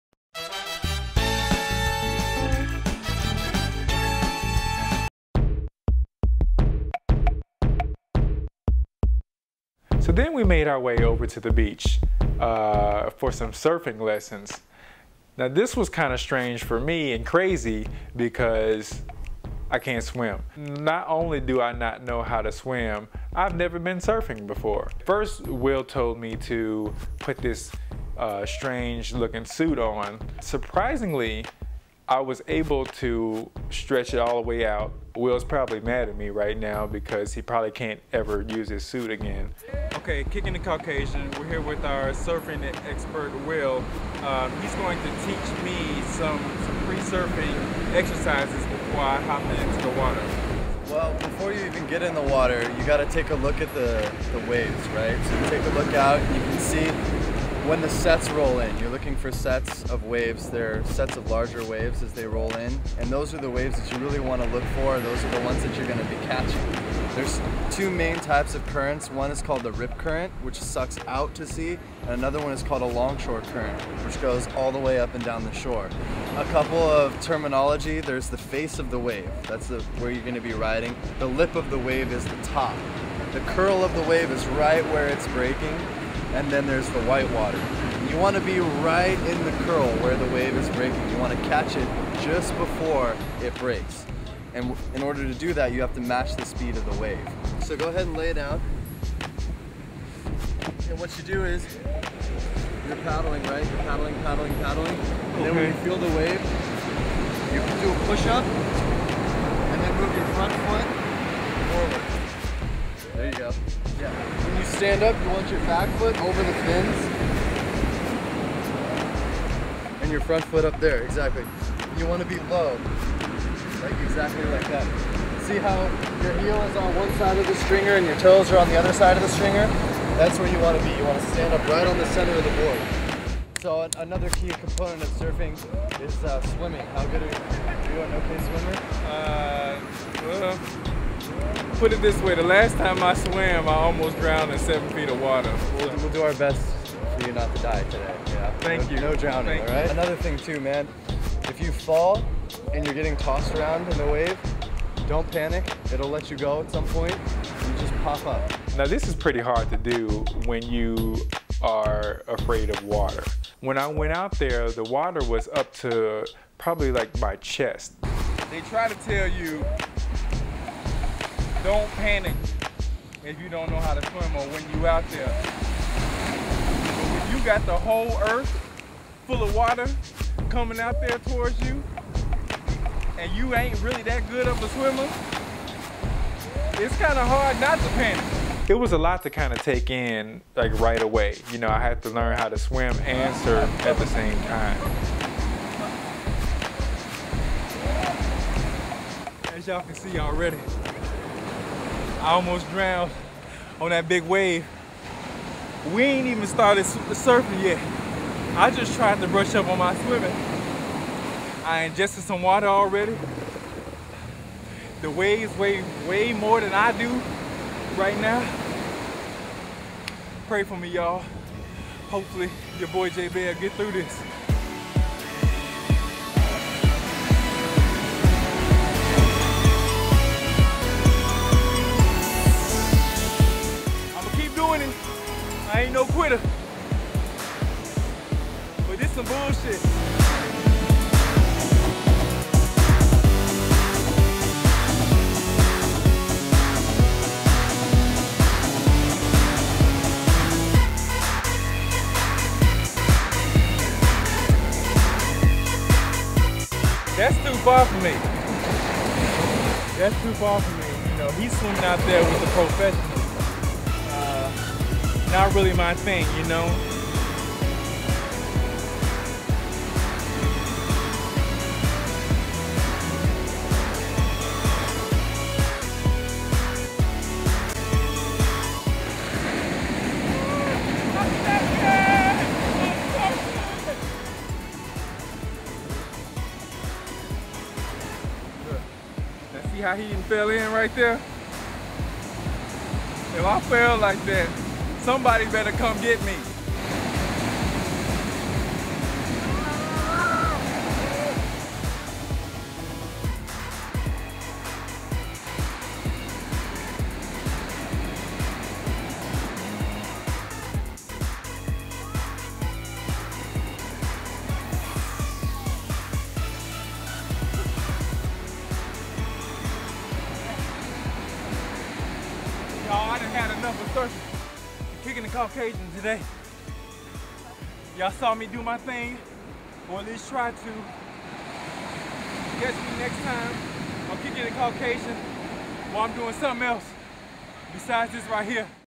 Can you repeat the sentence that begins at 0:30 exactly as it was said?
Surprisingly, I was able to stretch it all the way out.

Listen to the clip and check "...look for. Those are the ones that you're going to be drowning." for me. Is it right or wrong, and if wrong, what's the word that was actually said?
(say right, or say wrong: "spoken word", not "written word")
wrong: "catching", not "drowning".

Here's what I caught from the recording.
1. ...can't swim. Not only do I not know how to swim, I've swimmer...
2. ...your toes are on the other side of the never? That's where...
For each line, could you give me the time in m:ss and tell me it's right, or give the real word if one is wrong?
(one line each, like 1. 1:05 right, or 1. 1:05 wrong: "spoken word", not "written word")
1. 0:19 wrong: "never", not "swimmer"
2. 2:08 wrong: "stringer", not "never".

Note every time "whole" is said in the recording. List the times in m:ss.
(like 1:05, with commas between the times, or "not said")
2:57.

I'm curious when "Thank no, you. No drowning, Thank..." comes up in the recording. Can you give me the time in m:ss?
2:28.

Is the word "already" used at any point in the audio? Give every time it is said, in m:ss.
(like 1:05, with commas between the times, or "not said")
3:20, 3:32.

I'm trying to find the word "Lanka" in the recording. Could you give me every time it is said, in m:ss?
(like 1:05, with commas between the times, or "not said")
not said.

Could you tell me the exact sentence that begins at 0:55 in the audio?
So you take a look out you can see when the sets roll in, you're looking for sets of waves.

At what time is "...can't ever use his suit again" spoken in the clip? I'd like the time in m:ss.
0:37.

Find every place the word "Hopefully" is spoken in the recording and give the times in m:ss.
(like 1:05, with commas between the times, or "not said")
3:42.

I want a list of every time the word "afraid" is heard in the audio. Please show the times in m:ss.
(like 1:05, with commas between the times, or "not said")
2:42.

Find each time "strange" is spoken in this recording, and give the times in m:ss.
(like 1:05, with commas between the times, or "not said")
0:16, 0:28.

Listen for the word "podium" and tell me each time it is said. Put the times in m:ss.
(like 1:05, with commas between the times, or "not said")
not said.